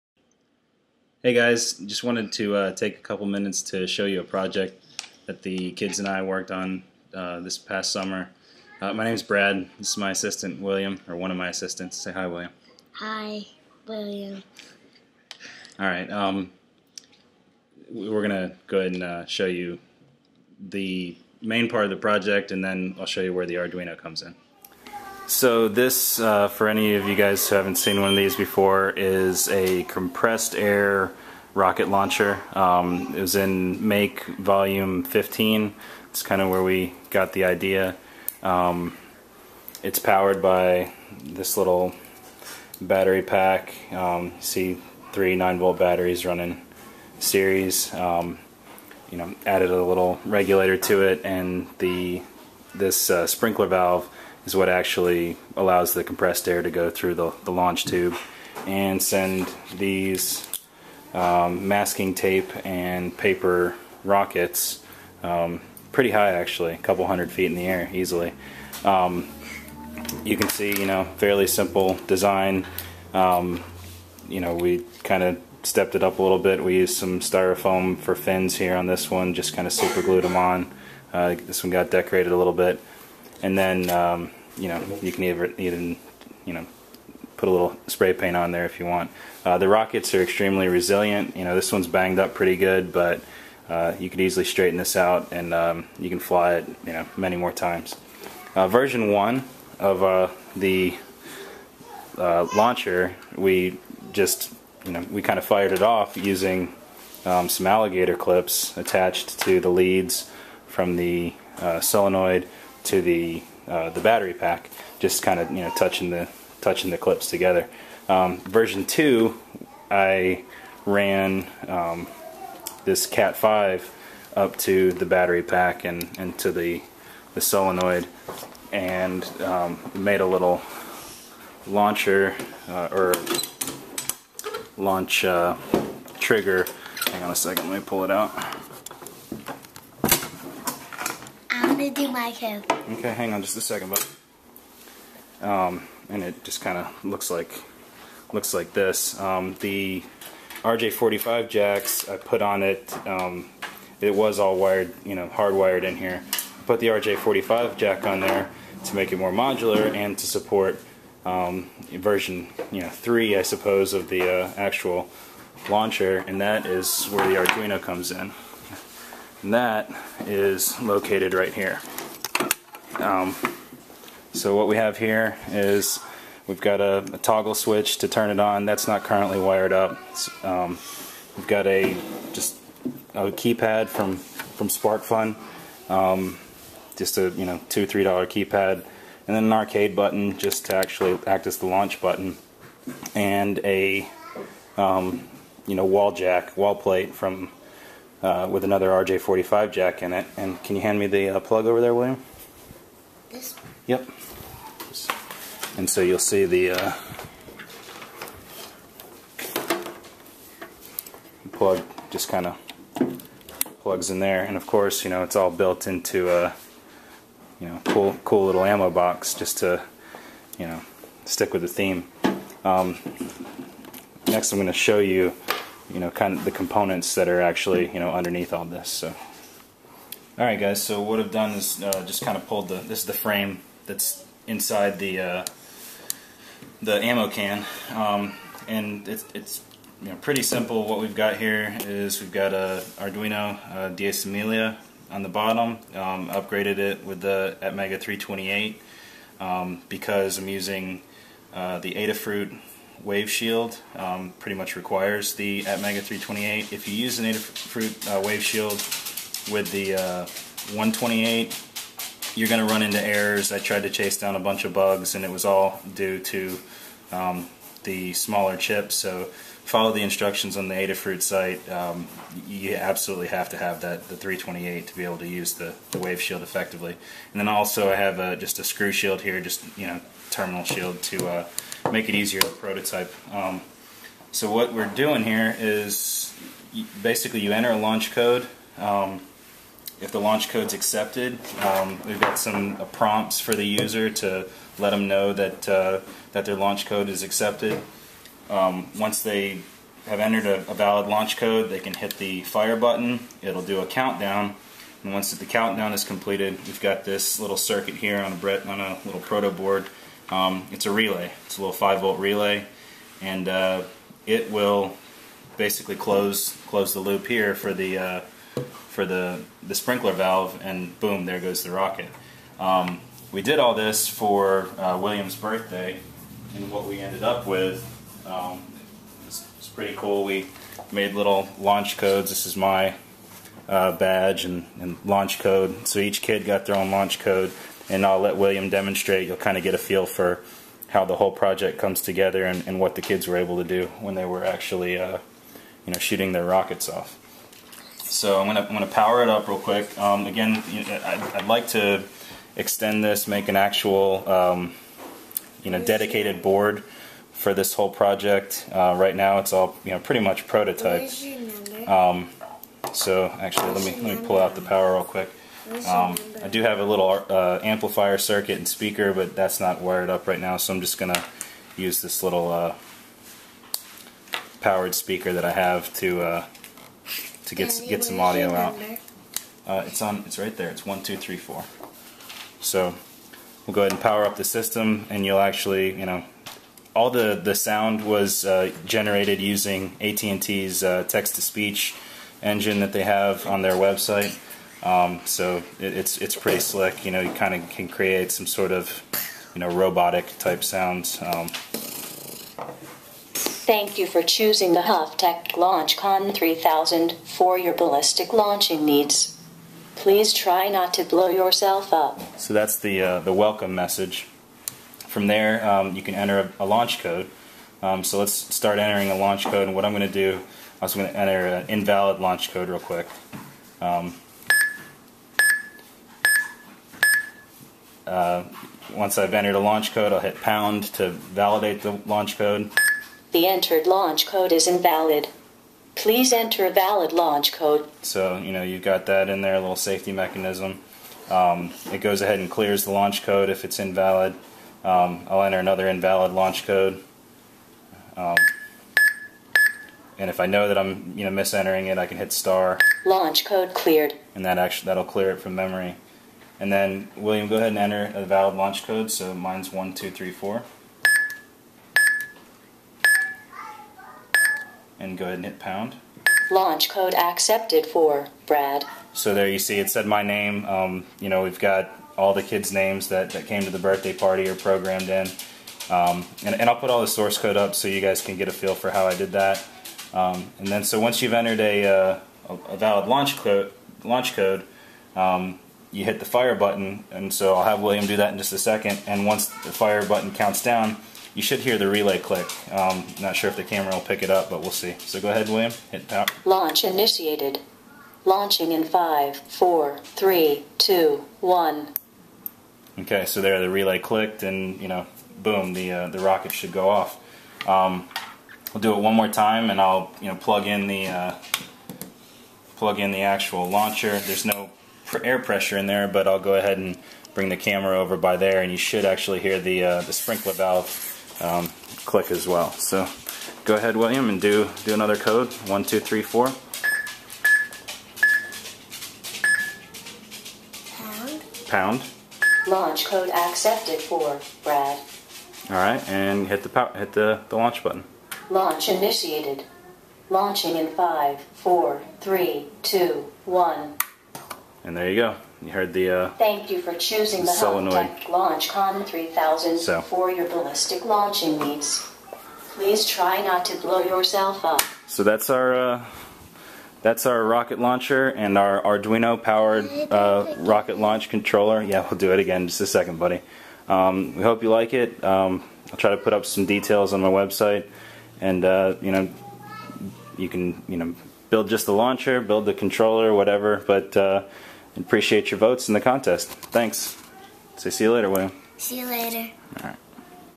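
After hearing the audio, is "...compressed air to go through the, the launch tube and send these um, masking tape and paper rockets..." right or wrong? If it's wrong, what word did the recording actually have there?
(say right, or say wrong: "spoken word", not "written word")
right.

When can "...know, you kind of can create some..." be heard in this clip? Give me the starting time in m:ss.
6:37.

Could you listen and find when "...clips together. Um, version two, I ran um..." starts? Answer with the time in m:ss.
1:56.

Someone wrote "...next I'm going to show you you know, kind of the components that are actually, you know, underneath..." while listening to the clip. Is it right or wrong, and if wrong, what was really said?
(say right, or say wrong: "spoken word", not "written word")
right.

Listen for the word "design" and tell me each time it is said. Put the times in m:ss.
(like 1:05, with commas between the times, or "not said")
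1:12.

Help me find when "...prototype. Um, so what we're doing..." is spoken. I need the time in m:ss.
4:42.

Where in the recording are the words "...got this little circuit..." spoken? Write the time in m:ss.
5:06.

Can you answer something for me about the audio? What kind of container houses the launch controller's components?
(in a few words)
ammo box.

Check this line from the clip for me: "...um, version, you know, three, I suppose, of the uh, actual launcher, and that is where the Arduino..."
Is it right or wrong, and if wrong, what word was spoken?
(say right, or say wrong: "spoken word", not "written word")
right.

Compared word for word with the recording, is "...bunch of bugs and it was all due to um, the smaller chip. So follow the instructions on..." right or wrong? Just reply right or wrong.
right.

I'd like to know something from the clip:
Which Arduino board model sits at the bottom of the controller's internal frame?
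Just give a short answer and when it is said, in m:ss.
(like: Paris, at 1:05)
Diecimila, at 4:03.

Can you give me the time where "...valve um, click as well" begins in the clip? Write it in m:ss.
8:40.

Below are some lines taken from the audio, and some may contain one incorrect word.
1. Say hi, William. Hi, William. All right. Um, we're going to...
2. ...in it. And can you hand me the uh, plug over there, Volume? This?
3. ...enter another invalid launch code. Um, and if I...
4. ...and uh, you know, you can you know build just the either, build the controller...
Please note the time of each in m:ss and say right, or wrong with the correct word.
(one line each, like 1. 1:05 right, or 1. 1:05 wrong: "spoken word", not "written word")
1. 0:11 right
2. 3:20 wrong: "William", not "Volume"
3. 7:25 right
4. 9:28 wrong: "launcher", not "either".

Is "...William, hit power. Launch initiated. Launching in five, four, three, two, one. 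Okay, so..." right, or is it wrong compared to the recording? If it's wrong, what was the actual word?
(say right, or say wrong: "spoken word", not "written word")
right.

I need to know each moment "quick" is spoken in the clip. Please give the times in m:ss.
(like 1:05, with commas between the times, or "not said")
5:49, 6:05, 7:02.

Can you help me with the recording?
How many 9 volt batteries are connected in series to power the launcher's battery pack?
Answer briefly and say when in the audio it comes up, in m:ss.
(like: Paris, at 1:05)
3, at 0:45.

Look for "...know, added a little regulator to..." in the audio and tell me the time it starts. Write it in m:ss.
0:49.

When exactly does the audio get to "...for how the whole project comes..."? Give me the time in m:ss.
5:40.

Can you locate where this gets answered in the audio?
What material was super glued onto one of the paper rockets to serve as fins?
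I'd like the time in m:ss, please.
1:17.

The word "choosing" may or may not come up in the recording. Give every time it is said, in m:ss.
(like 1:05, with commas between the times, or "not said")
6:44, 9:06.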